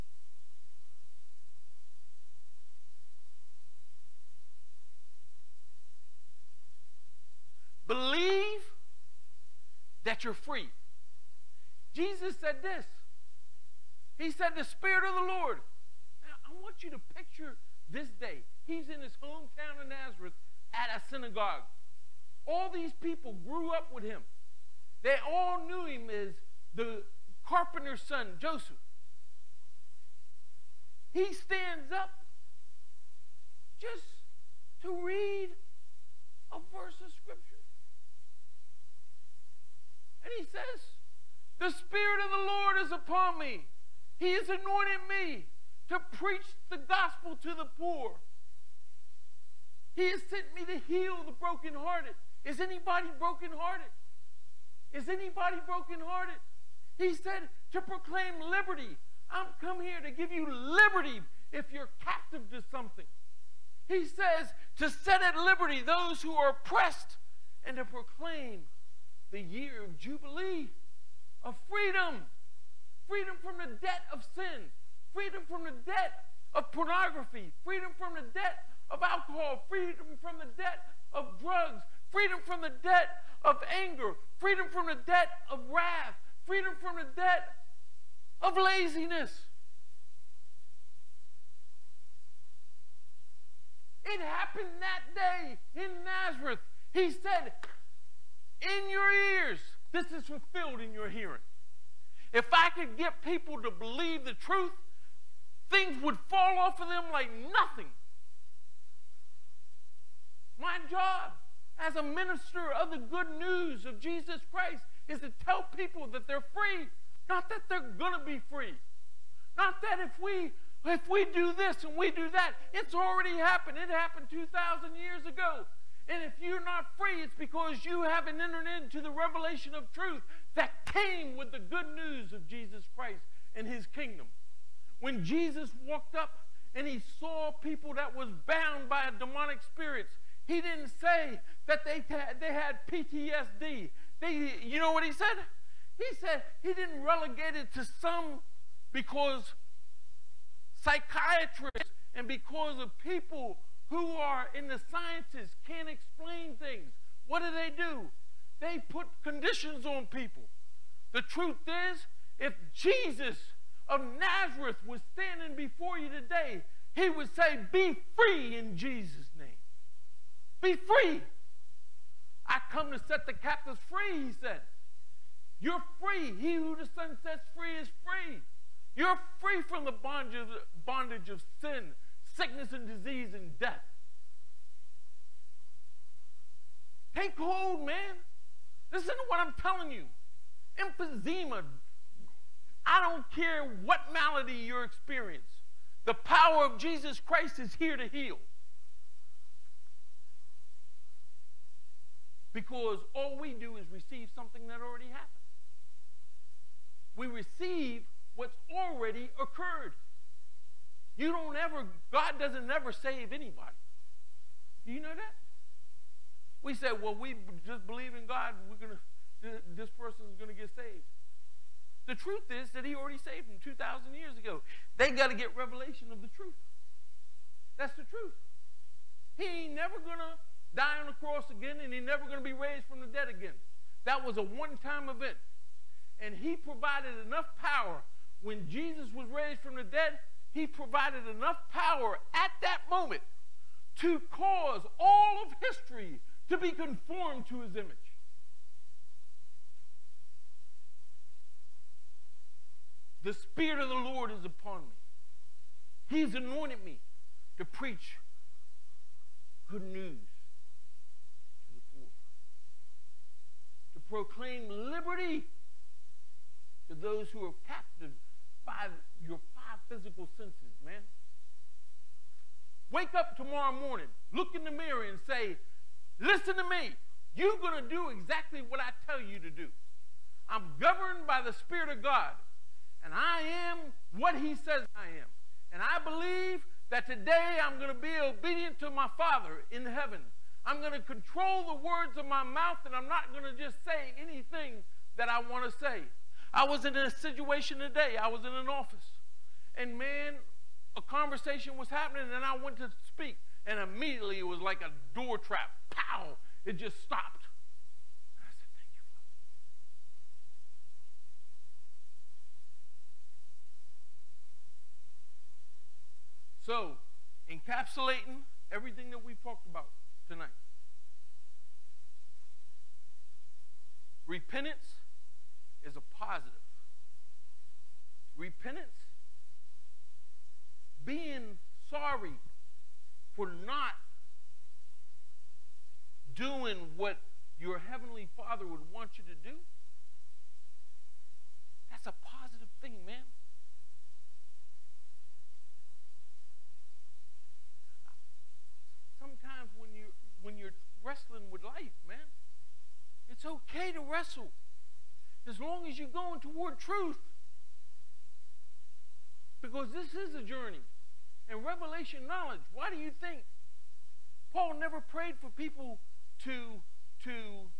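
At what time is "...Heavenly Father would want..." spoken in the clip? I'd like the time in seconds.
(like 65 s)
337 s.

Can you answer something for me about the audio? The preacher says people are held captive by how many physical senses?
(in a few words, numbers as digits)
5.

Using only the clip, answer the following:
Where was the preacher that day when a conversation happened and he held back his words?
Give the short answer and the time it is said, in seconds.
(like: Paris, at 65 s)
An office, at 298 s.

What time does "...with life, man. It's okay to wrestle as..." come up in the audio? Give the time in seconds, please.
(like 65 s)
351 s.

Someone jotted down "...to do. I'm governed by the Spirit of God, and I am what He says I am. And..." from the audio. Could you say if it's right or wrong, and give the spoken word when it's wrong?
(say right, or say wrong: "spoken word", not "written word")
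right.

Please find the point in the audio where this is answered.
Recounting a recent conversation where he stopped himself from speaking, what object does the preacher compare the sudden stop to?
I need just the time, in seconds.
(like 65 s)
305 s.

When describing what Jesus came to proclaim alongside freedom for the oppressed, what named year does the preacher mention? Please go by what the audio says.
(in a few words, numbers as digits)
Year of Jubilee.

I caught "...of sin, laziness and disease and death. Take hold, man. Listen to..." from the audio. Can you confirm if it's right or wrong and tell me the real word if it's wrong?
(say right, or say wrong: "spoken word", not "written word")
wrong: "sickness", not "laziness".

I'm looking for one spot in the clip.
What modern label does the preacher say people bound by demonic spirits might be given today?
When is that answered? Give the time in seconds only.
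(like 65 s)
142 s.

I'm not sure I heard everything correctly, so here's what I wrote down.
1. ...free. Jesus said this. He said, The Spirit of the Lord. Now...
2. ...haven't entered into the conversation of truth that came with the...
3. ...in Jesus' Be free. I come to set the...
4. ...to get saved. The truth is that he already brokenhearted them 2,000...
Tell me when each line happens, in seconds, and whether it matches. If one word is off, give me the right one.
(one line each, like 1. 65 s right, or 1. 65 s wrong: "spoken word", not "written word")
1. 10 s right
2. 128 s wrong: "revelation", not "conversation"
3. 168 s right
4. 220 s wrong: "saved", not "brokenhearted".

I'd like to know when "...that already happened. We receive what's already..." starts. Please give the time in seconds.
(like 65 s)
204 s.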